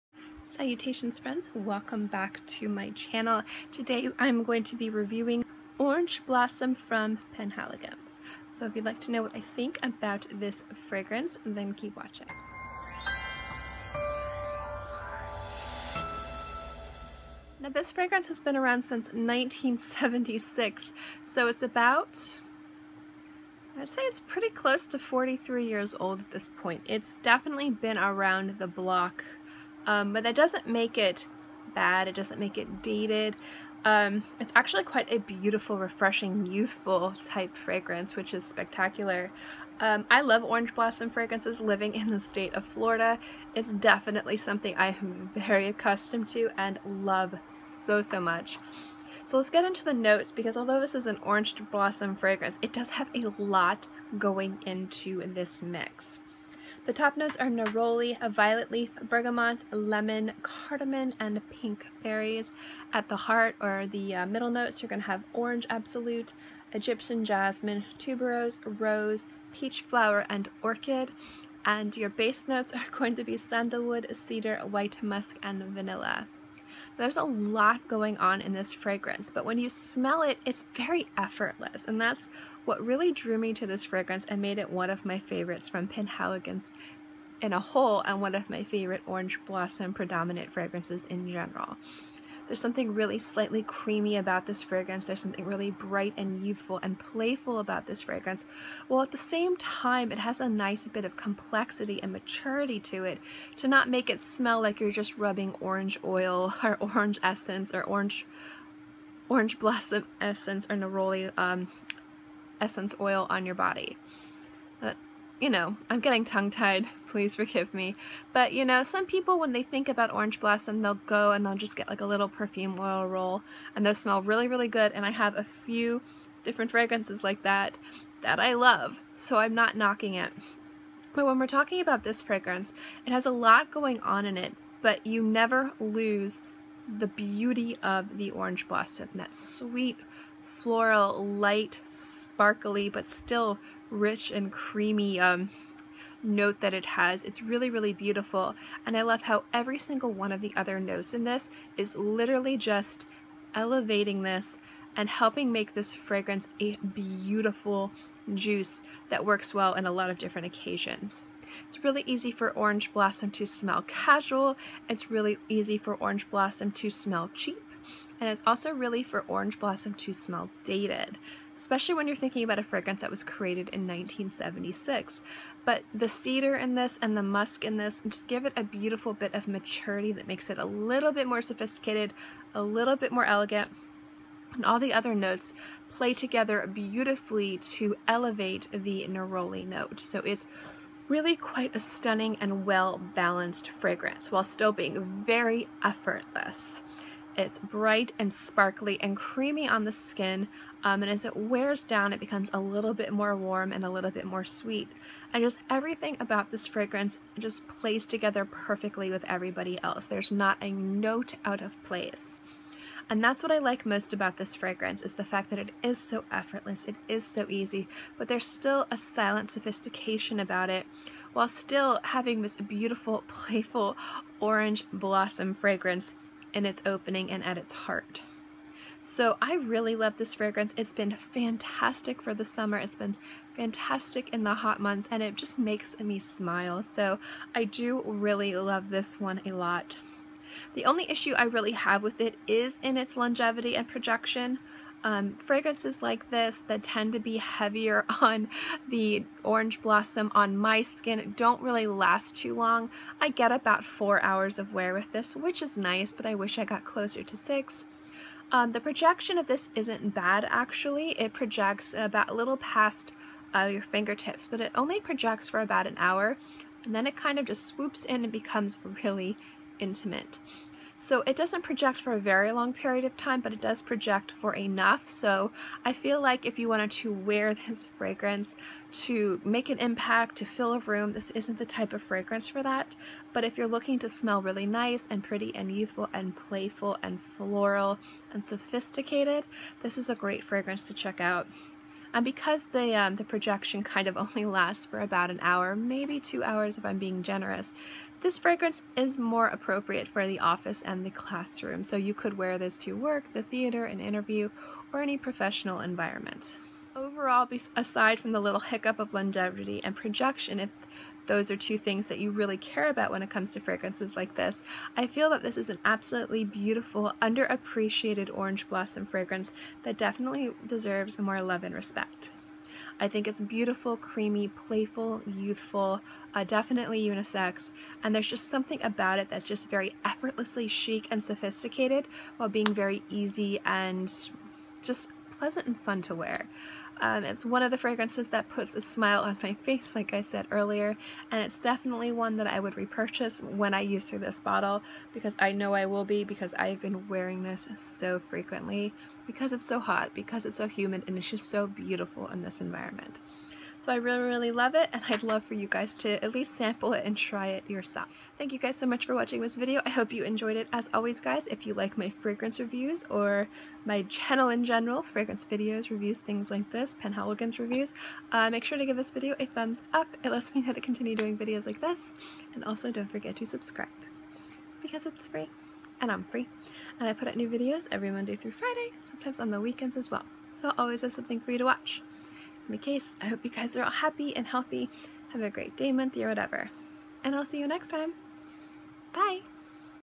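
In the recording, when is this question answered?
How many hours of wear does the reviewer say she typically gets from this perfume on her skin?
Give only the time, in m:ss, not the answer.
4:13.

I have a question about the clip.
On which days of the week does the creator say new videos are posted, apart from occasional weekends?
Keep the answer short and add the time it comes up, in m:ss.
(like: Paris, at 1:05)
Monday through Friday, at 6:18.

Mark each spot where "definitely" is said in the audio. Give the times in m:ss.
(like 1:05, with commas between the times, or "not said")
0:27, 0:43, 5:19, 5:26, 5:41.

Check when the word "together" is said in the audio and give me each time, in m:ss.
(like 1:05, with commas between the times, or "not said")
3:06, 3:28.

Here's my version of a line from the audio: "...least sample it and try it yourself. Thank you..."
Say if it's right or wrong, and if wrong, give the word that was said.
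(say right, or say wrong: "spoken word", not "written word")
right.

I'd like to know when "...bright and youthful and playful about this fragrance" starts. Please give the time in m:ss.
1:35.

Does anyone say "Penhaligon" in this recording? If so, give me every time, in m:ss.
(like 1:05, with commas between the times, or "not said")
0:07, 1:25.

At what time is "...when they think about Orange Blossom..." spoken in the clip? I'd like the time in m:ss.
1:59.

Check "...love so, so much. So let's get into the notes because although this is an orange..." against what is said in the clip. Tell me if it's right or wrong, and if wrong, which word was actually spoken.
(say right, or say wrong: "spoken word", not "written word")
right.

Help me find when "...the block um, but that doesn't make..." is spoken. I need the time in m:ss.
0:28.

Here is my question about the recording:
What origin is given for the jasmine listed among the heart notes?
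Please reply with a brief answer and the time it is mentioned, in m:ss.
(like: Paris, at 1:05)
Egyptian, at 1:06.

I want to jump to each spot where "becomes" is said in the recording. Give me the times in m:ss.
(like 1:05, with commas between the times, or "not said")
3:22, 4:28.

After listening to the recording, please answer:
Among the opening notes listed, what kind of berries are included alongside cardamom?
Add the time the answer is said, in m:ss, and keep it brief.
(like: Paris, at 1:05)
pink berries, at 1:01.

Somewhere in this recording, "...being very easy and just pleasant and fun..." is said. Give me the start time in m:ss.
5:32.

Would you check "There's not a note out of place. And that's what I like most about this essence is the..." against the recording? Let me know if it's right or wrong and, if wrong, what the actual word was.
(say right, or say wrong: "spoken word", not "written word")
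wrong: "fragrance", not "essence".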